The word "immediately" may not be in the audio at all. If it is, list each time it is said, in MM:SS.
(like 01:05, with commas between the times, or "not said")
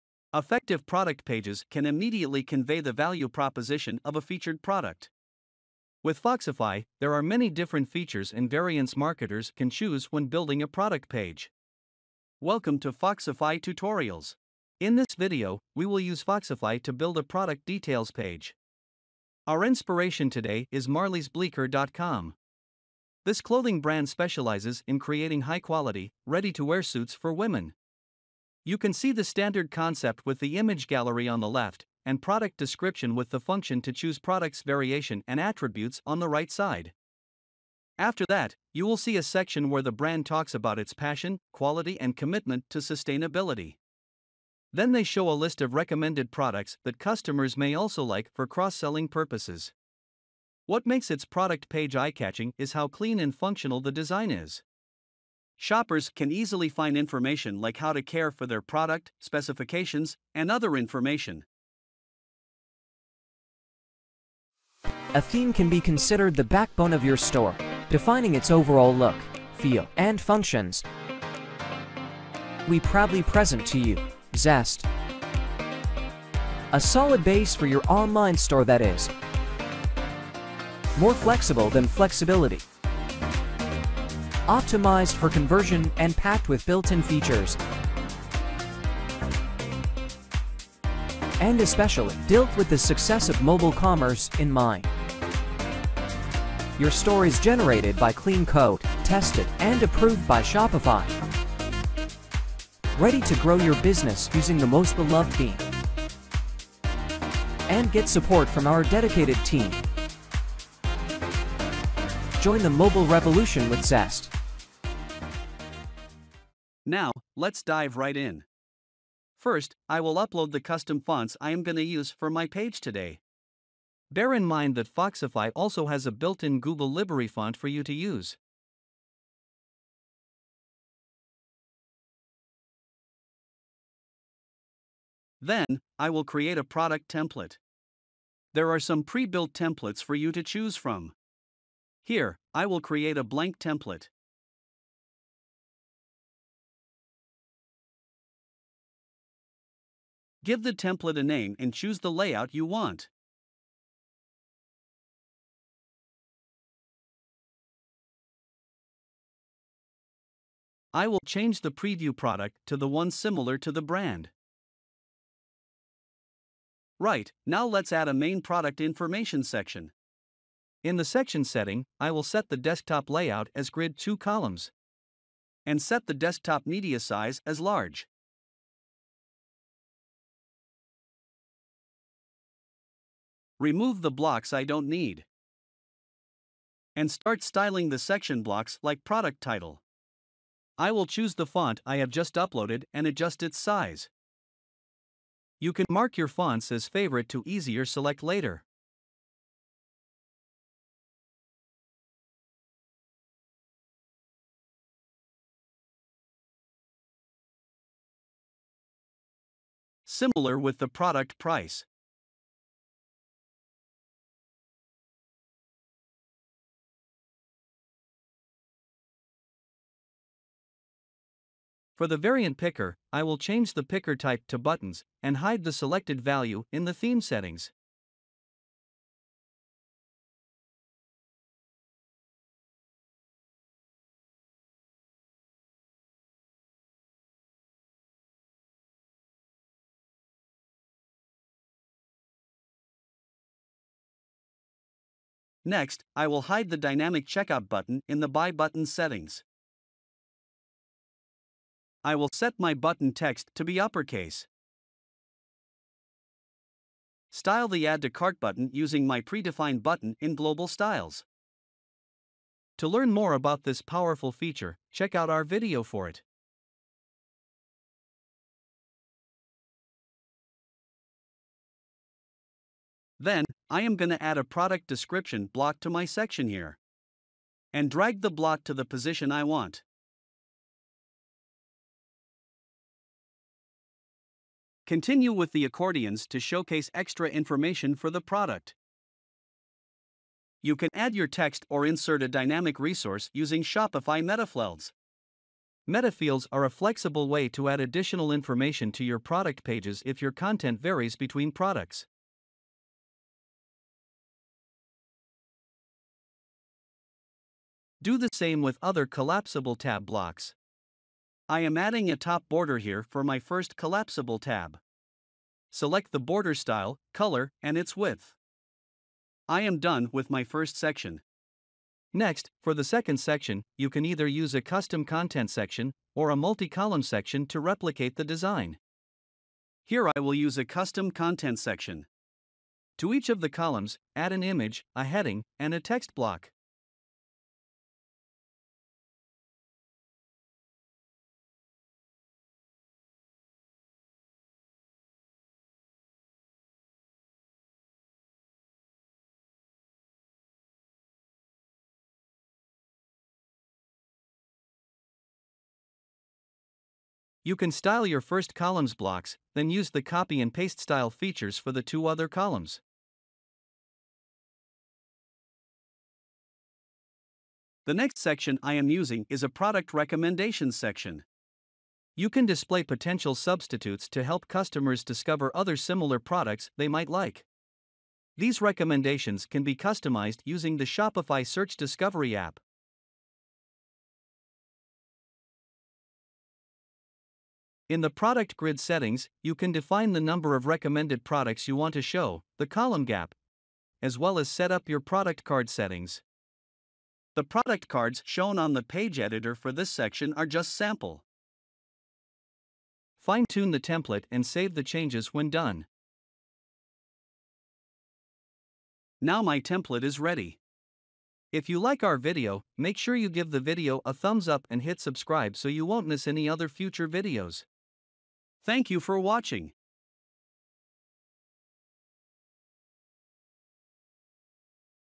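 00:01.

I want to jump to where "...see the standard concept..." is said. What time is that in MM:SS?
00:28.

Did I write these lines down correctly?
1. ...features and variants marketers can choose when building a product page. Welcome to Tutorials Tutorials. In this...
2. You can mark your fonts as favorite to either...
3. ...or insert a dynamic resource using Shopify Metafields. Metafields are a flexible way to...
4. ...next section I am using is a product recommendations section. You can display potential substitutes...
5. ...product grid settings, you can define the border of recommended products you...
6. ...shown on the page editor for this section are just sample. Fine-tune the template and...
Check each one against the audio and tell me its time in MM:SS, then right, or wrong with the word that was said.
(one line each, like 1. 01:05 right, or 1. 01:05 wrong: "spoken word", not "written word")
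1. 00:07 wrong: "Foxify", not "Tutorials"
2. 03:15 wrong: "easier", not "either"
3. 04:51 right
4. 06:07 right
5. 06:28 wrong: "number", not "border"
6. 06:38 right.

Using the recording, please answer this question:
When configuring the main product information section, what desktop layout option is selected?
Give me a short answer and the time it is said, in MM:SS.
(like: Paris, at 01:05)
grid 2 columns, at 02:53.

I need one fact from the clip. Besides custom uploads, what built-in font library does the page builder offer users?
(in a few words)
Google Library.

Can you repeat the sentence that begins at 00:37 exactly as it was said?
After that, you will see a section where the brand talks about its passion, quality, and commitment to sustainability.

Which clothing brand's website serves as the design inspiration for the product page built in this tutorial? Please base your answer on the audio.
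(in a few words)
marliesbleeker.com.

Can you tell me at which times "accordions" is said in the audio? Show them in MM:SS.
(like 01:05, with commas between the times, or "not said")
04:45.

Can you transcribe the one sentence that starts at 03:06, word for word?
And start styling the section blocks like product title.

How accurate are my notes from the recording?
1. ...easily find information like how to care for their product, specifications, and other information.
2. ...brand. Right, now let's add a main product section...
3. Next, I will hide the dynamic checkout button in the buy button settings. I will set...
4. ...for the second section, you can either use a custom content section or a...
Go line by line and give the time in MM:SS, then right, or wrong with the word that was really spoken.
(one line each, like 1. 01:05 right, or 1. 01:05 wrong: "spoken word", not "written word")
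1. 00:56 right
2. 02:43 wrong: "information", not "section"
3. 04:05 right
4. 05:22 right.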